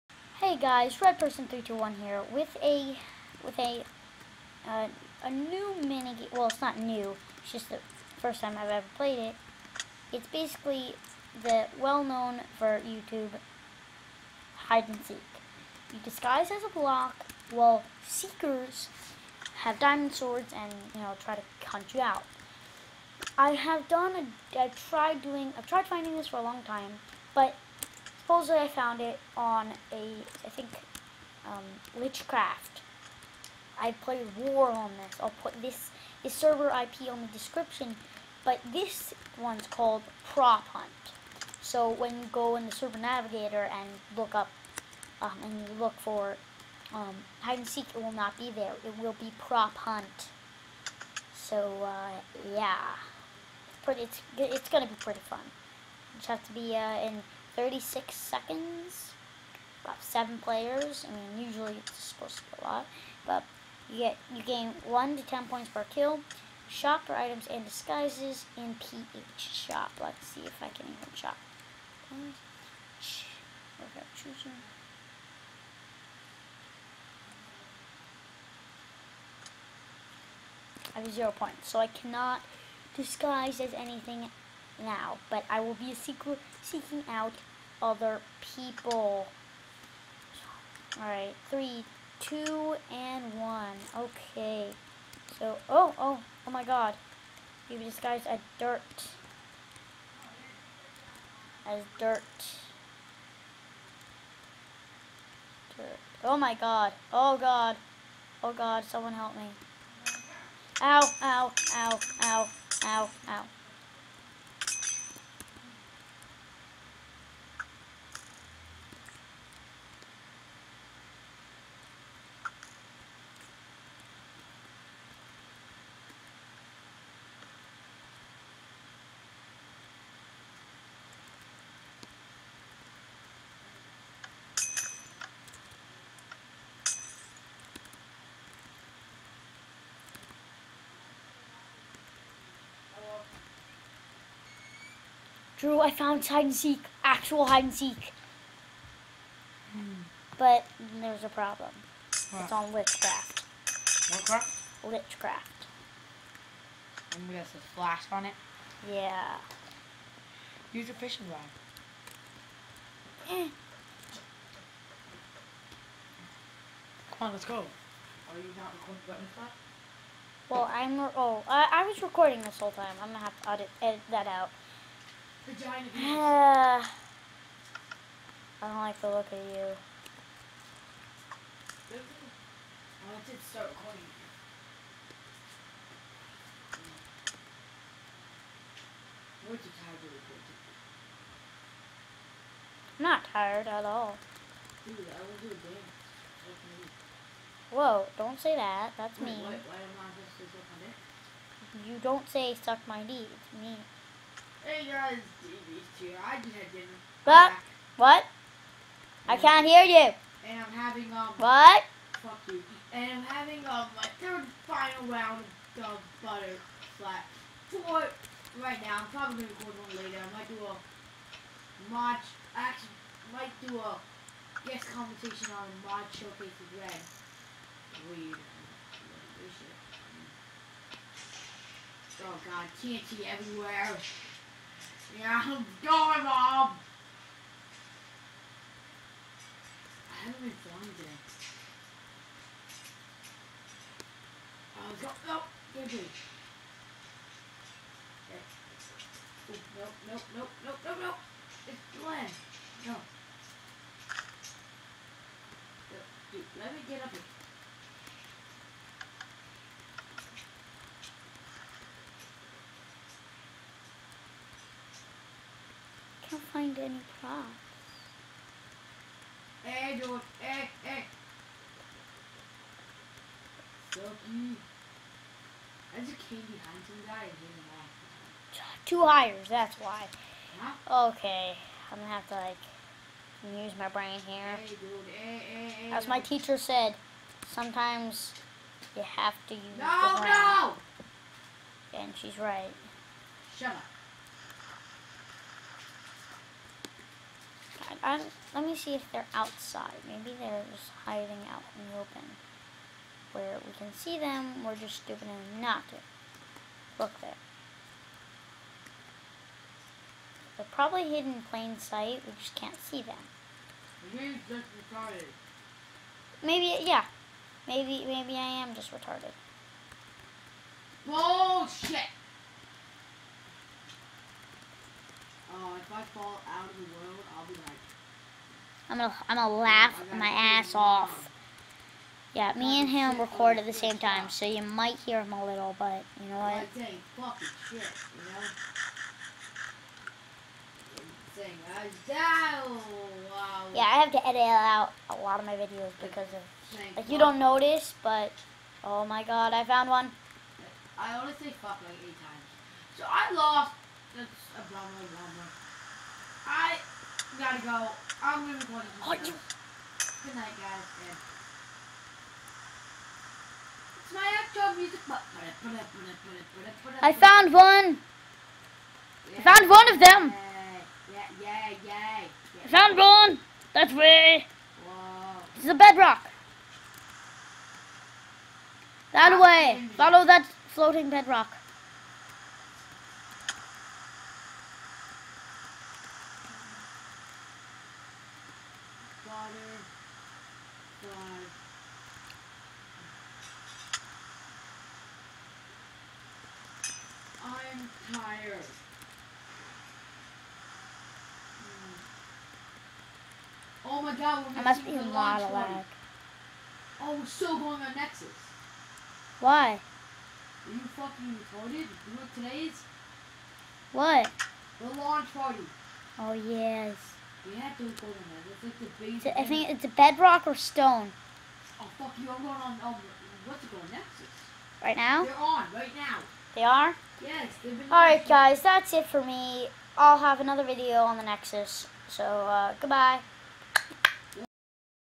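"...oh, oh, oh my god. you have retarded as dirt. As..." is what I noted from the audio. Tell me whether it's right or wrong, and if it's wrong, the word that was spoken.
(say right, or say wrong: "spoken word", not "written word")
wrong: "disguised", not "retarded".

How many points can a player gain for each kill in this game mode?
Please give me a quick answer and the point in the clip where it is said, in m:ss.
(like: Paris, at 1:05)
1 to 10, at 1:04.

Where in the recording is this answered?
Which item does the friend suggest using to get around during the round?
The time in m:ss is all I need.
2:40.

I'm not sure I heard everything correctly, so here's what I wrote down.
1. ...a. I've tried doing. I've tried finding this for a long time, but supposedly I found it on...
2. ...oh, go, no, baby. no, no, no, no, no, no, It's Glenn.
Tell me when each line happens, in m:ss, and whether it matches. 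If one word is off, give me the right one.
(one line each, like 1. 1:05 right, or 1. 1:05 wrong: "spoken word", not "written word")
1. 0:24 right
2. 4:04 right.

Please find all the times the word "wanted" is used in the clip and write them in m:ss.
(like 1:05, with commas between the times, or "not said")
3:03.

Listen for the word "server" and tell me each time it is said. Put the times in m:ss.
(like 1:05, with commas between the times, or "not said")
0:36, 0:42.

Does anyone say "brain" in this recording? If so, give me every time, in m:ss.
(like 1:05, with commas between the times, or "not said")
4:43, 4:50.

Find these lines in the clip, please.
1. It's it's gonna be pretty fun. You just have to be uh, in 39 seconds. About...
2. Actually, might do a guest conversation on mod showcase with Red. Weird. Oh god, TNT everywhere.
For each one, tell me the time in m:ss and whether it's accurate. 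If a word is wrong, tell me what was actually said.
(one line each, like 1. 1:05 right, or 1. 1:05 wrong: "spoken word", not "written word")
1. 0:54 wrong: "36", not "39"
2. 3:42 right.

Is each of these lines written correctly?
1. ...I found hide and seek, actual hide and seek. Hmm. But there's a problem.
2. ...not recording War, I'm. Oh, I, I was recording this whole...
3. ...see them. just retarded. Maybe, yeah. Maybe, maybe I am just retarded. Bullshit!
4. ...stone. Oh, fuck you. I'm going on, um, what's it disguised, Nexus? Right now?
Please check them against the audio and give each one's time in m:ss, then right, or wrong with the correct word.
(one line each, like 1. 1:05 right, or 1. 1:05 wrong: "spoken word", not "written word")
1. 2:25 right
2. 2:48 wrong: "Well", not "War"
3. 5:12 right
4. 7:00 wrong: "called", not "disguised".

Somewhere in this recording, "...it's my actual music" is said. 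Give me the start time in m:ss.
6:04.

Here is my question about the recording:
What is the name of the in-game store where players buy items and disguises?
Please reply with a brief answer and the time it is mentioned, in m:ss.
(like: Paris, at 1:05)
PH shop, at 1:08.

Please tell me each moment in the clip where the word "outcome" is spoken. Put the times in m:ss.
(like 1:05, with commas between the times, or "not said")
not said.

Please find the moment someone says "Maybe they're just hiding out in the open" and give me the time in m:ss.
5:00.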